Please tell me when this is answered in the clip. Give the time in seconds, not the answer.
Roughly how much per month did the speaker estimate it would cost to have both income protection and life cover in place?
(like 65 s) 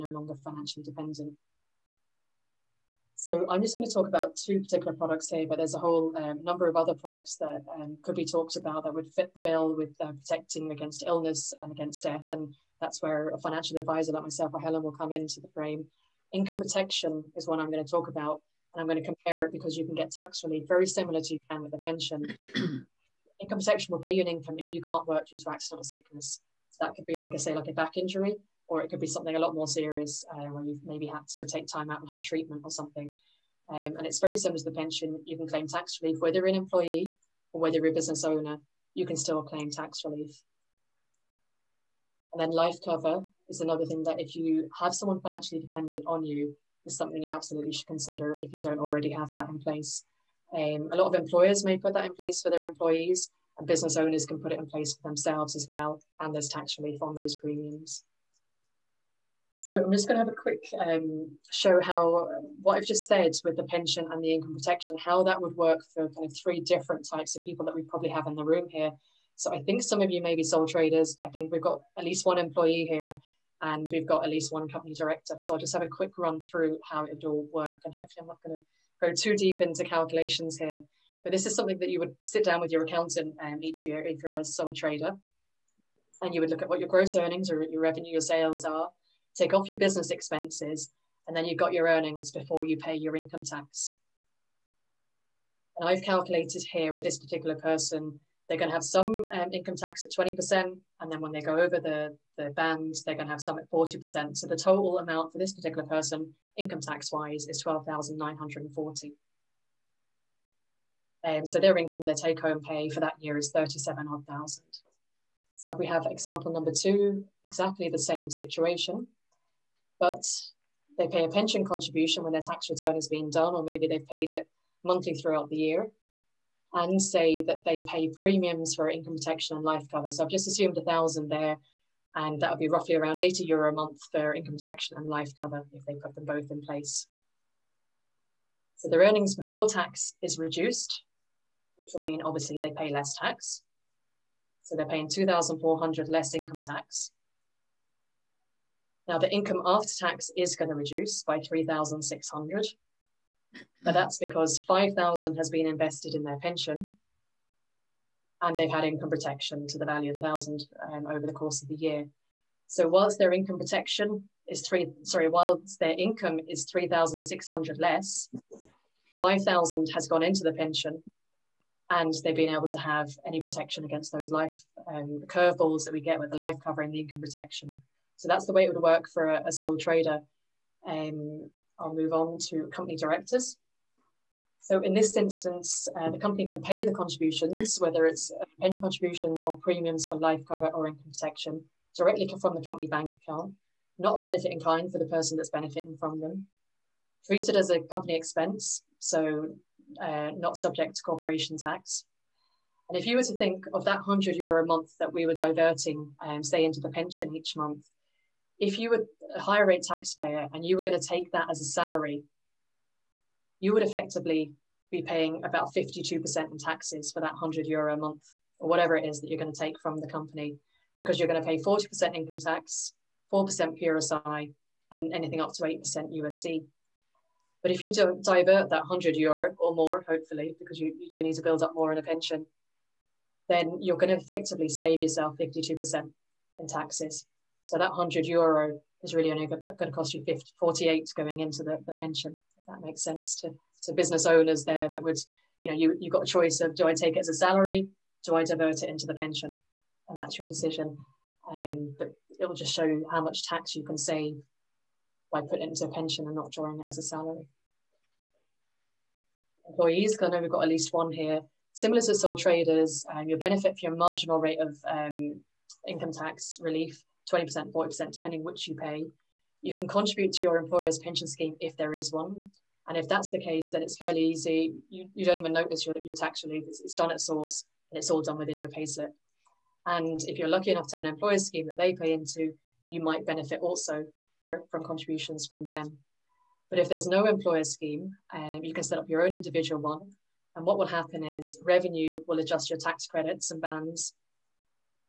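133 s.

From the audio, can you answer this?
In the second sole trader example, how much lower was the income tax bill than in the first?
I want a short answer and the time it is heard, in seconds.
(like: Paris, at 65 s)
2,400, at 145 s.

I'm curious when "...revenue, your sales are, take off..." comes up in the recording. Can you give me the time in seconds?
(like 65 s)
87 s.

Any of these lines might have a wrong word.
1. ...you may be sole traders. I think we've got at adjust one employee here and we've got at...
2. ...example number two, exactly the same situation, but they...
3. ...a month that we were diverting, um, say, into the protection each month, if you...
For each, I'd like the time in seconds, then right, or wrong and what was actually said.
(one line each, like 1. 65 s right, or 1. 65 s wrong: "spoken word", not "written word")
1. 70 s wrong: "least", not "adjust"
2. 116 s right
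3. 204 s wrong: "pension", not "protection".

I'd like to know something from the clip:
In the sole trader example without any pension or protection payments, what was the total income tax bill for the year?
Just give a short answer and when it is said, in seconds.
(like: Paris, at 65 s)
12,940, at 107 s.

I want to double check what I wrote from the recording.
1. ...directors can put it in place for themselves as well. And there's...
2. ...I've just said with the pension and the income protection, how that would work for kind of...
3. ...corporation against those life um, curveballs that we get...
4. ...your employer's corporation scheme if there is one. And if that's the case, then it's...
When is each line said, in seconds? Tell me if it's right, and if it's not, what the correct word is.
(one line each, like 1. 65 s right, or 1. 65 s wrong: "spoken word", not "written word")
1. 53 s wrong: "owners", not "directors"
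2. 62 s right
3. 173 s wrong: "protection", not "corporation"
4. 270 s wrong: "pension", not "corporation".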